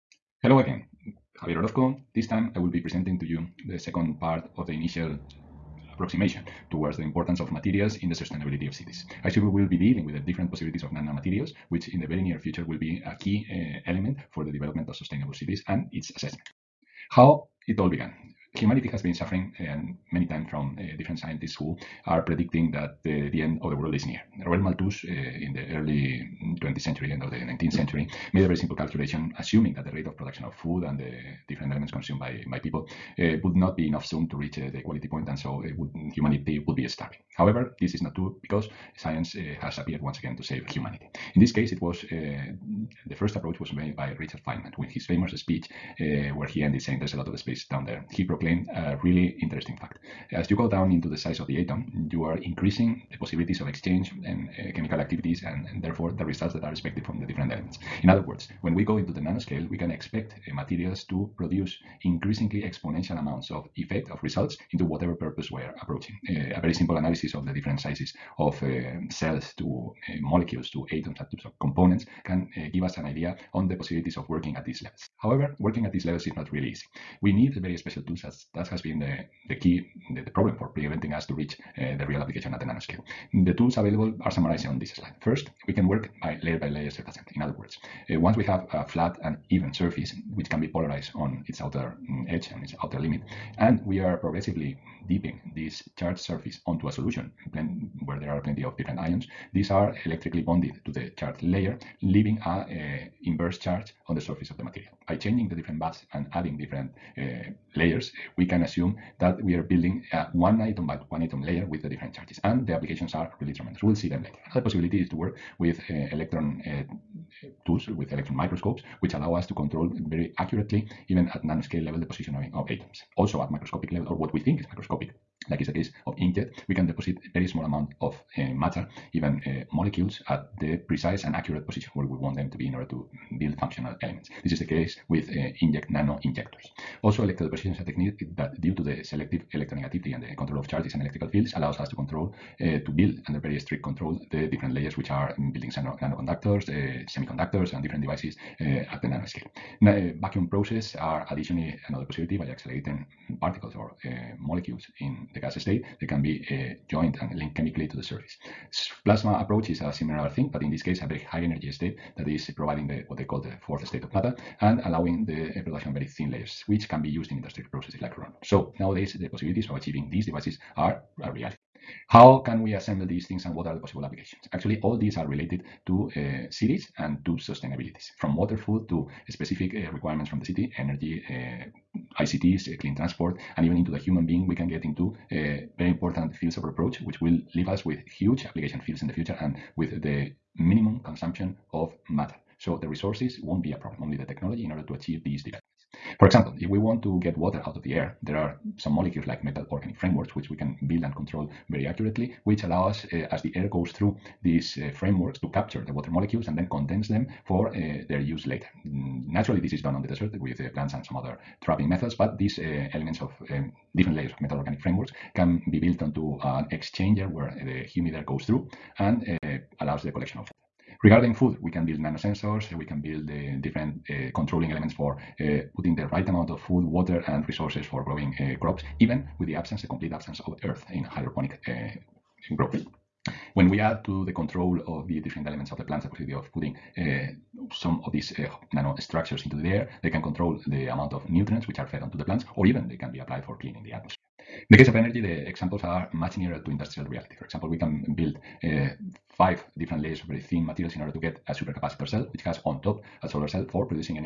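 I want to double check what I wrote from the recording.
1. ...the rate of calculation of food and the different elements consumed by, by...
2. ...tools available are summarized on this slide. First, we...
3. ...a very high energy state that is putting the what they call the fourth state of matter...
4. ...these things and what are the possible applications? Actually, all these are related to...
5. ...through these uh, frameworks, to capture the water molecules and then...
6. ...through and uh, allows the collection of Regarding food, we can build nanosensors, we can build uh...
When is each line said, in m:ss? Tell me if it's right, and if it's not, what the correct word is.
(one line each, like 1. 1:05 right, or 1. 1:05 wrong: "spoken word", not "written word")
1. 0:29 wrong: "production", not "calculation"
2. 1:23 right
3. 2:41 wrong: "providing", not "putting"
4. 2:53 right
5. 3:23 right
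6. 3:38 right.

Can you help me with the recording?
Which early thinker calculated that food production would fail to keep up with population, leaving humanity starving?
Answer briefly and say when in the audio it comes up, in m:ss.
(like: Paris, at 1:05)
Robert Malthus, at 0:24.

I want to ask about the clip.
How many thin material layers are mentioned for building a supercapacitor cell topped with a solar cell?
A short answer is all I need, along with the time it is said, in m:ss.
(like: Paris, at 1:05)
5, at 4:09.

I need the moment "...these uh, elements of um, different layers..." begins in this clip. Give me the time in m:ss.
3:32.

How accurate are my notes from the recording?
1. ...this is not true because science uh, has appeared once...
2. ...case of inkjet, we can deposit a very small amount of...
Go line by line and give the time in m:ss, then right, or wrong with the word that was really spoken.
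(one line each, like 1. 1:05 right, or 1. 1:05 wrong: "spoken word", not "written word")
1. 0:37 right
2. 2:05 right.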